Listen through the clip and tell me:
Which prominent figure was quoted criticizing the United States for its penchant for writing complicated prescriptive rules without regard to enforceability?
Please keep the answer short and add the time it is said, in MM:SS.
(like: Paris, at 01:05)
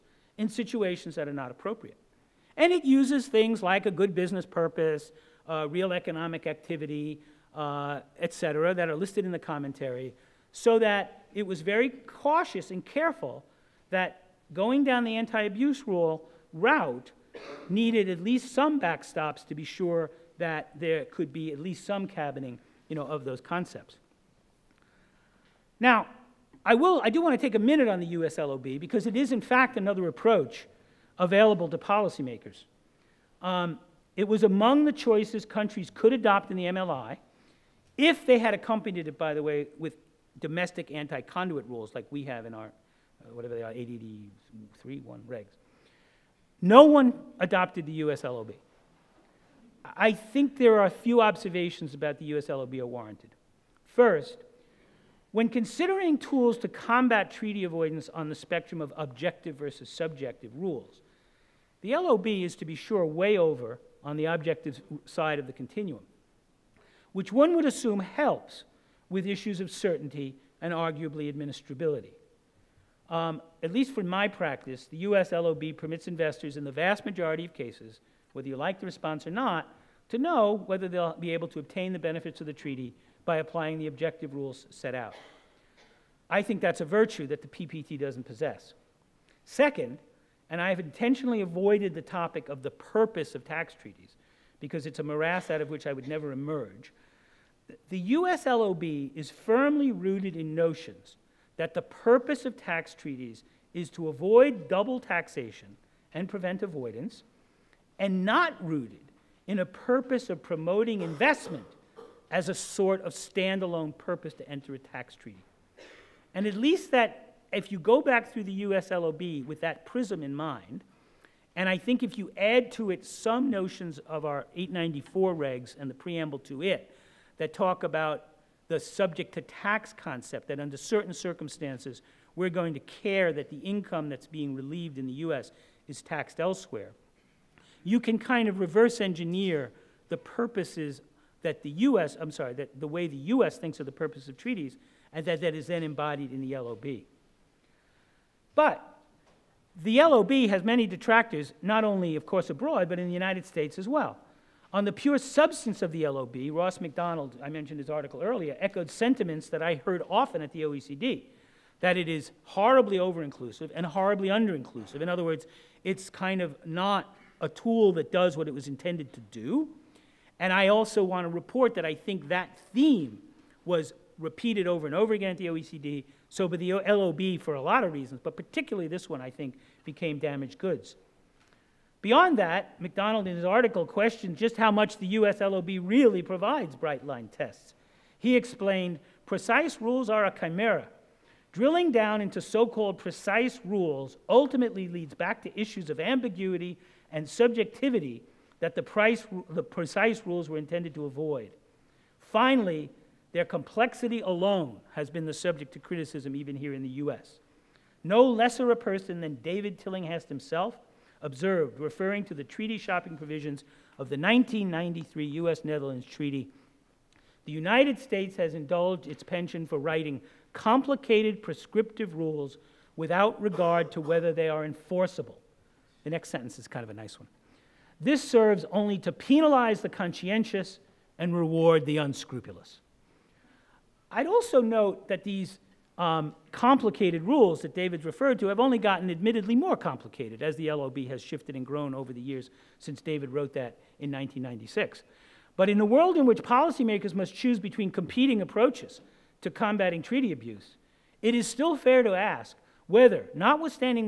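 David Tillinghast, at 03:29.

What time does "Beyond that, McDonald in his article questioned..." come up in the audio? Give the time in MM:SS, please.
03:02.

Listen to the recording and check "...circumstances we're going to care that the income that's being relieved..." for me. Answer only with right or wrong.
right.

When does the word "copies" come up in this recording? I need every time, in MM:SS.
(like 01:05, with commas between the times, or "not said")
not said.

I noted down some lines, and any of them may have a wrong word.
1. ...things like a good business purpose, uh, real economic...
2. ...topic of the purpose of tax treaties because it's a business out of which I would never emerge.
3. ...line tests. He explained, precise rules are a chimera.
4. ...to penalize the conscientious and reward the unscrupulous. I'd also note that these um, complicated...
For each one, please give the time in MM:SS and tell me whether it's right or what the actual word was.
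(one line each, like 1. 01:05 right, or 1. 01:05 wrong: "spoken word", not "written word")
1. 00:03 right
2. 01:32 wrong: "morass", not "business"
3. 03:07 right
4. 03:48 right.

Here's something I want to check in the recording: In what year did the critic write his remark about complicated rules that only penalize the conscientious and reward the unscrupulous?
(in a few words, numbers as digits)
1996.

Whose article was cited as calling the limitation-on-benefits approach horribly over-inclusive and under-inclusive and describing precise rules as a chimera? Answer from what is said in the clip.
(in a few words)
Ross McDonald.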